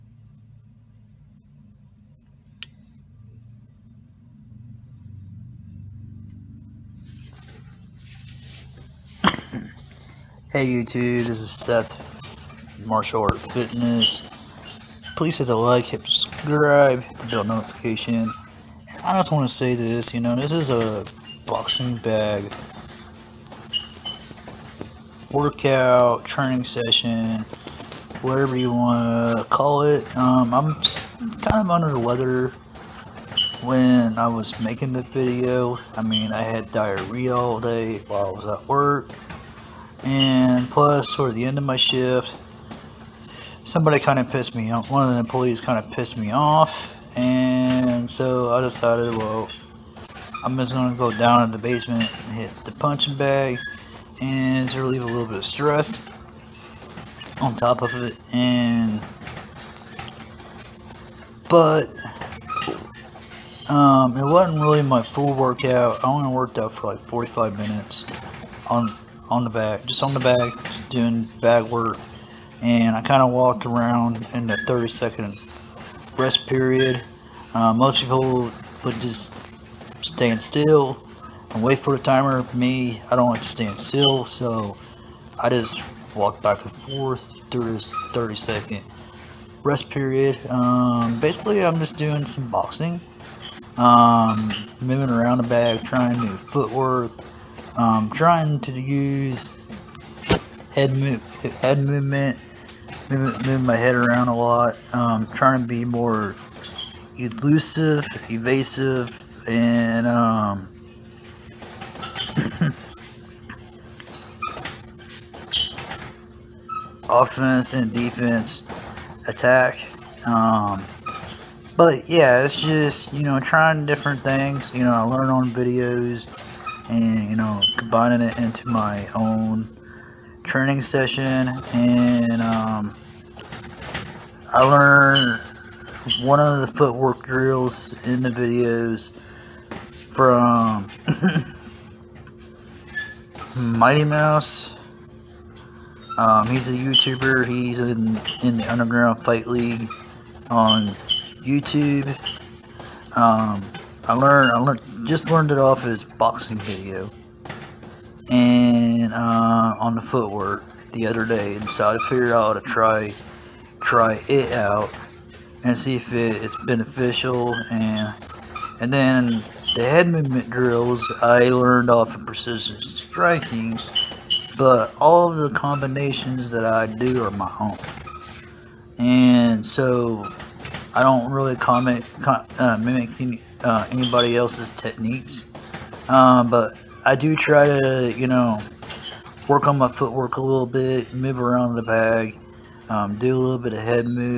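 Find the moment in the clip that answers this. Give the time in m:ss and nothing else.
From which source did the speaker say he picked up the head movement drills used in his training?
2:52.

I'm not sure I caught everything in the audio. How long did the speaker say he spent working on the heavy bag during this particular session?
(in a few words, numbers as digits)
45 minutes.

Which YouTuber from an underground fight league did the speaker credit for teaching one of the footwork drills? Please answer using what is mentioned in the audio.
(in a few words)
Mighty Mouse.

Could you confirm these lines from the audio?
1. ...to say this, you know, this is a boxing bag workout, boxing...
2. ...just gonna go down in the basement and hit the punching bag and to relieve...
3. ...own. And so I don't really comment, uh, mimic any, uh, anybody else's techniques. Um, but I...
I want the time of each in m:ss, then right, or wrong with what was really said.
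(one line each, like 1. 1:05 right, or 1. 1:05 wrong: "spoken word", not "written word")
1. 0:19 wrong: "training", not "boxing"
2. 0:50 right
3. 2:57 right.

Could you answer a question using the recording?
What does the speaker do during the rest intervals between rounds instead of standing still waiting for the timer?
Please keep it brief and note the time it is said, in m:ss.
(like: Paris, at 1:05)
walk back and forth, at 1:26.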